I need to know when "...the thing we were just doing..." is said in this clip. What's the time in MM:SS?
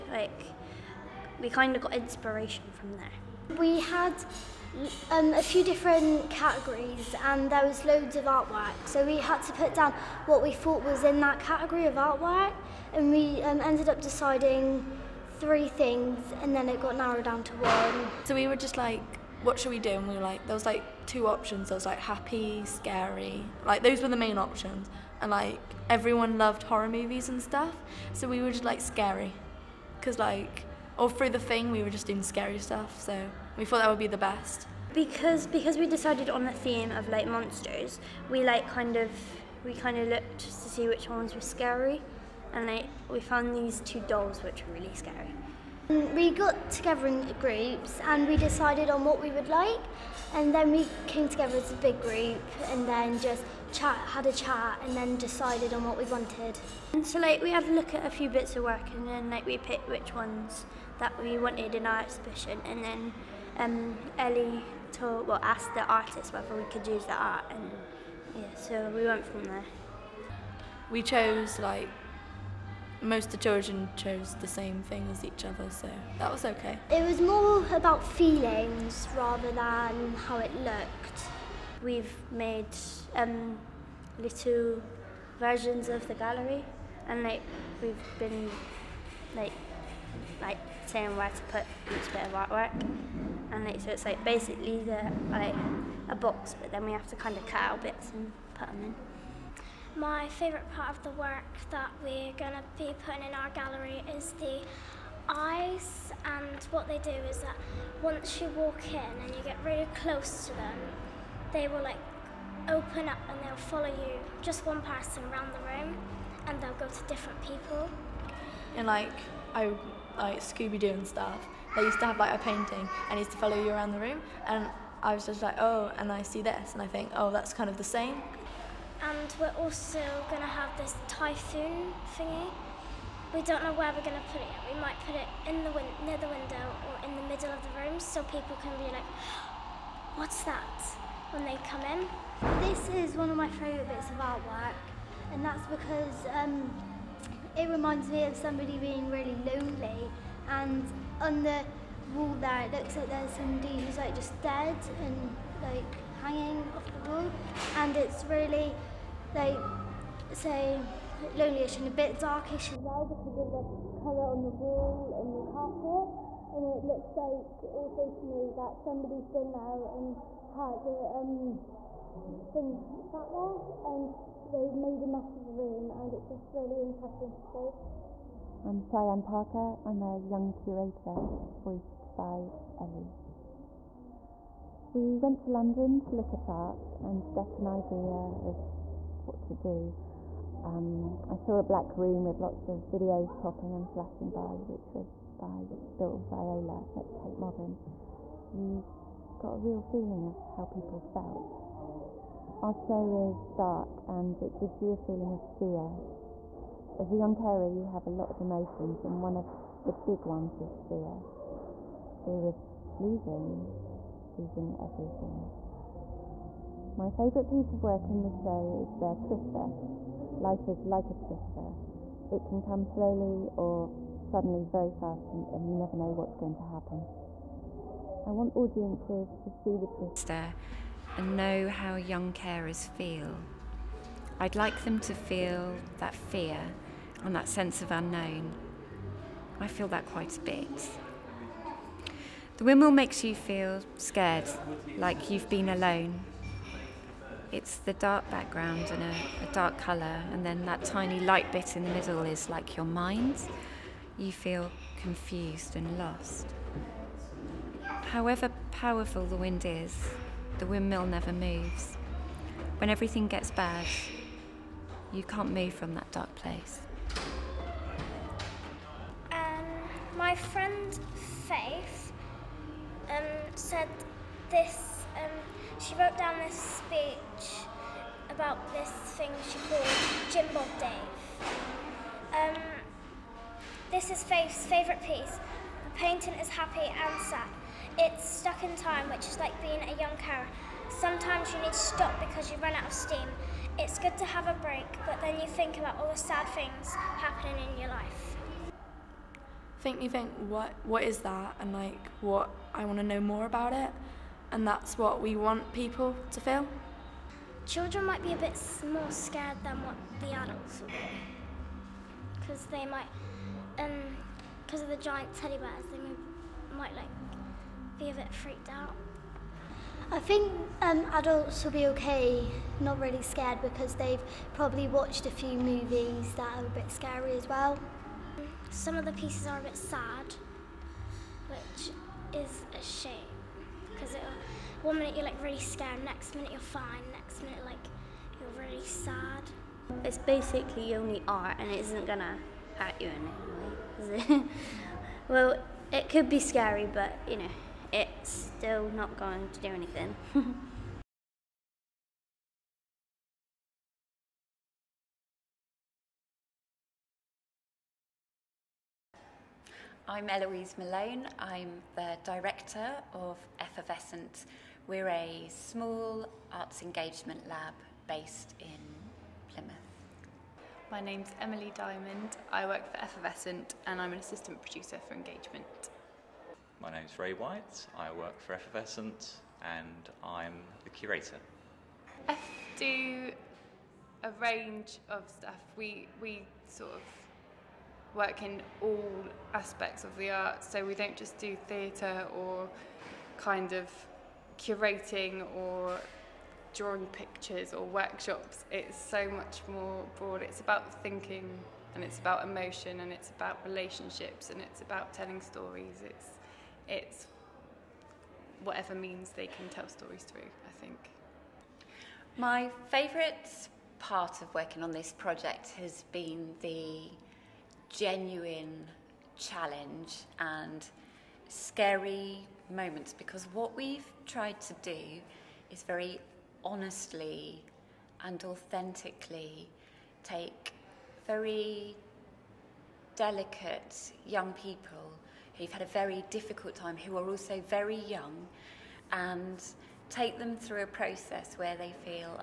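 00:31.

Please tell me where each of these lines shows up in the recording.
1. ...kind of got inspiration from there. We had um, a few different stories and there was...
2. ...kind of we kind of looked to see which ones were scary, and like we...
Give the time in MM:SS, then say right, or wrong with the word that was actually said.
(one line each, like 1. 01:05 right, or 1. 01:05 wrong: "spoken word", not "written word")
1. 00:01 wrong: "categories", not "stories"
2. 00:38 right.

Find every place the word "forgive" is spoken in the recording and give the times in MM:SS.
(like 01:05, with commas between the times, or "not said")
not said.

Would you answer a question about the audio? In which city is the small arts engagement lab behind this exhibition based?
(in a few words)
Plymouth.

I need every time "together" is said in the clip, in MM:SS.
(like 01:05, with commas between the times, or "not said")
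00:46, 00:51.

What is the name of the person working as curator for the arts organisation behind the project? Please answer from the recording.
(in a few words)
Ray White.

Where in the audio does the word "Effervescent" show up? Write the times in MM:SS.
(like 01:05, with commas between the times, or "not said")
06:03, 06:13, 06:18.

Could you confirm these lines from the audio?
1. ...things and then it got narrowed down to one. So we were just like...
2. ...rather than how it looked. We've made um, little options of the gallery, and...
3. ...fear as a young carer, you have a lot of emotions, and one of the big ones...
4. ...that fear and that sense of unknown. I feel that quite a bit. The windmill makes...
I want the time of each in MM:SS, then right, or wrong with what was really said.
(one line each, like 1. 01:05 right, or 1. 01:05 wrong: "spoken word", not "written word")
1. 00:15 right
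2. 01:19 wrong: "versions", not "options"
3. 03:25 right
4. 03:55 right.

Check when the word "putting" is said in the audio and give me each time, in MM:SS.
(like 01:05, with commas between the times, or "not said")
01:43.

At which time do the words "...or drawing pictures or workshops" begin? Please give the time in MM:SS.
06:35.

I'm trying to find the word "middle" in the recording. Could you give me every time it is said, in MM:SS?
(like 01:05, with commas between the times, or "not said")
02:17, 04:11.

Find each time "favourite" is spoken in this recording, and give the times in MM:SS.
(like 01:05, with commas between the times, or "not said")
01:40, 02:23, 03:37, 04:44, 06:52.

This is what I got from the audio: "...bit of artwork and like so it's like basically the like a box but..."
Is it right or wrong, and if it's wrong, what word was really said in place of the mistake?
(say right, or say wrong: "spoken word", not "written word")
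right.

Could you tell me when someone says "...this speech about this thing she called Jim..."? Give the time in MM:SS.
04:36.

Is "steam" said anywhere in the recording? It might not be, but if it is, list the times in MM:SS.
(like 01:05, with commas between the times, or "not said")
04:52.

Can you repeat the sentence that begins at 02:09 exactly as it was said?
And we're also going to have this typhoon thingy.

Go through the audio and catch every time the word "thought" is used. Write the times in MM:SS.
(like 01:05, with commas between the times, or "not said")
00:10, 00:33.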